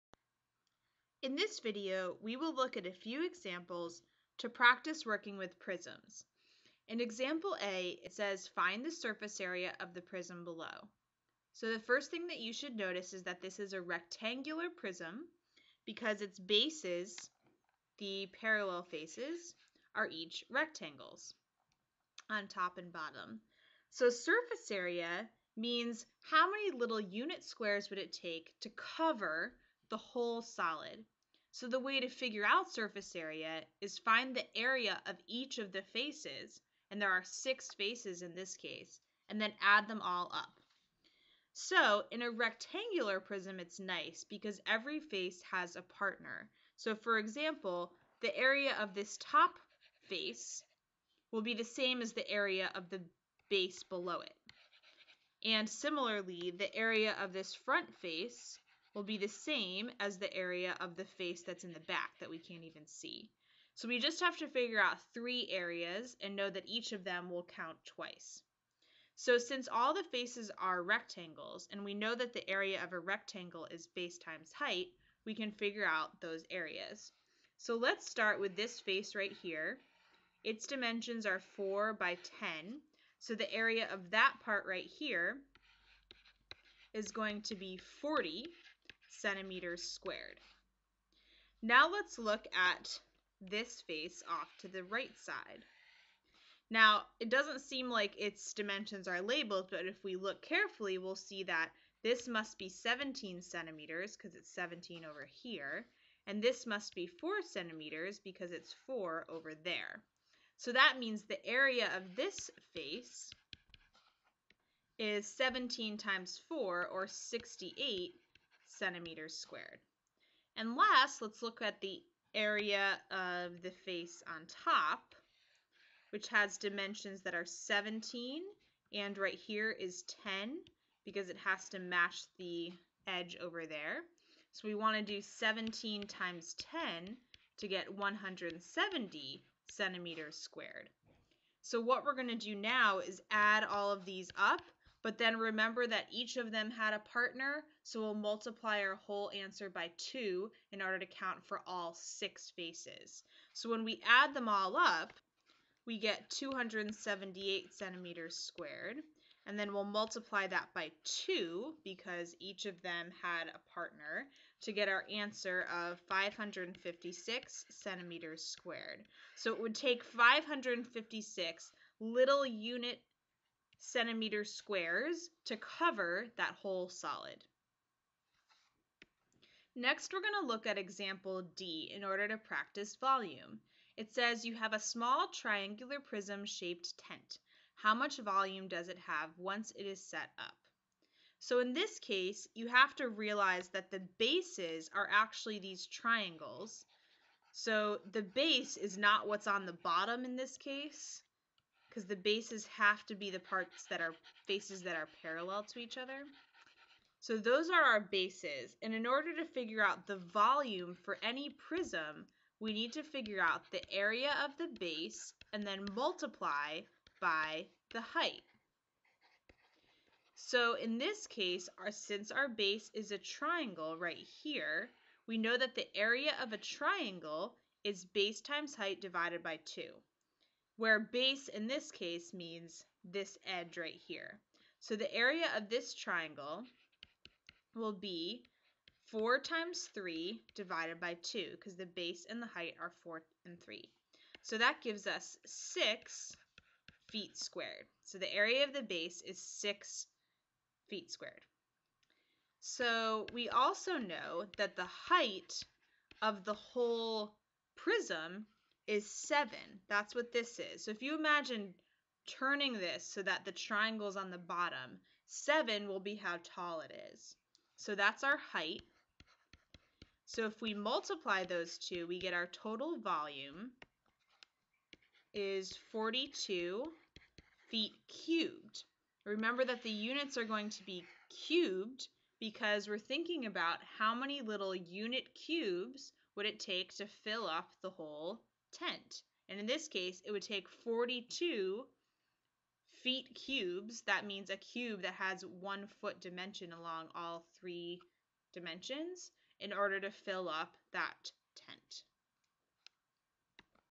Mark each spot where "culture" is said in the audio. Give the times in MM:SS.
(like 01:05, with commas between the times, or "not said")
not said.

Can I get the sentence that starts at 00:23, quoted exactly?
So surface area means how many little unit squares would it take to cover the whole solid.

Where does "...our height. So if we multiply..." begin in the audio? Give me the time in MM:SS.
04:28.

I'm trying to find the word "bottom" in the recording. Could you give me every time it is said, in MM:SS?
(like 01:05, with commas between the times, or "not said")
00:22, 03:19, 04:24.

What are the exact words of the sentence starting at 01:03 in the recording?
So we just have to figure out three areas and know that each of them will count twice.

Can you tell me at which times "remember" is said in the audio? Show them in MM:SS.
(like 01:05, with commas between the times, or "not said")
02:25, 04:39.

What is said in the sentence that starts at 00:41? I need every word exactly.
So in a rectangular prism, it's nice because every face has a partner.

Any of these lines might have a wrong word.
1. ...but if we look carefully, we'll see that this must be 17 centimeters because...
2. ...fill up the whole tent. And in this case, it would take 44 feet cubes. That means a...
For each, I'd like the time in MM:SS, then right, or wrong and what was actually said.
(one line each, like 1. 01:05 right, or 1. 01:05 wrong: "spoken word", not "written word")
1. 01:39 right
2. 04:47 wrong: "42", not "44".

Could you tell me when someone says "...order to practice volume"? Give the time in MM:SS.
03:02.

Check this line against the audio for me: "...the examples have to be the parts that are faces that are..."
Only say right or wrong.
wrong.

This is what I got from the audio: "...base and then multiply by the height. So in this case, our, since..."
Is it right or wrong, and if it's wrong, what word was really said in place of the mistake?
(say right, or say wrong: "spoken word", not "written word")
right.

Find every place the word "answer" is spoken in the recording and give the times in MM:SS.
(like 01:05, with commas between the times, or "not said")
02:29, 02:45.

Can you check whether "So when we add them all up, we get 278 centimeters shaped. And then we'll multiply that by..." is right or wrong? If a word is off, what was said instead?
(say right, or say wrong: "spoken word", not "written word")
wrong: "squared", not "shaped".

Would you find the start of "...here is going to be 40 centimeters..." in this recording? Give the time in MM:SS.
01:24.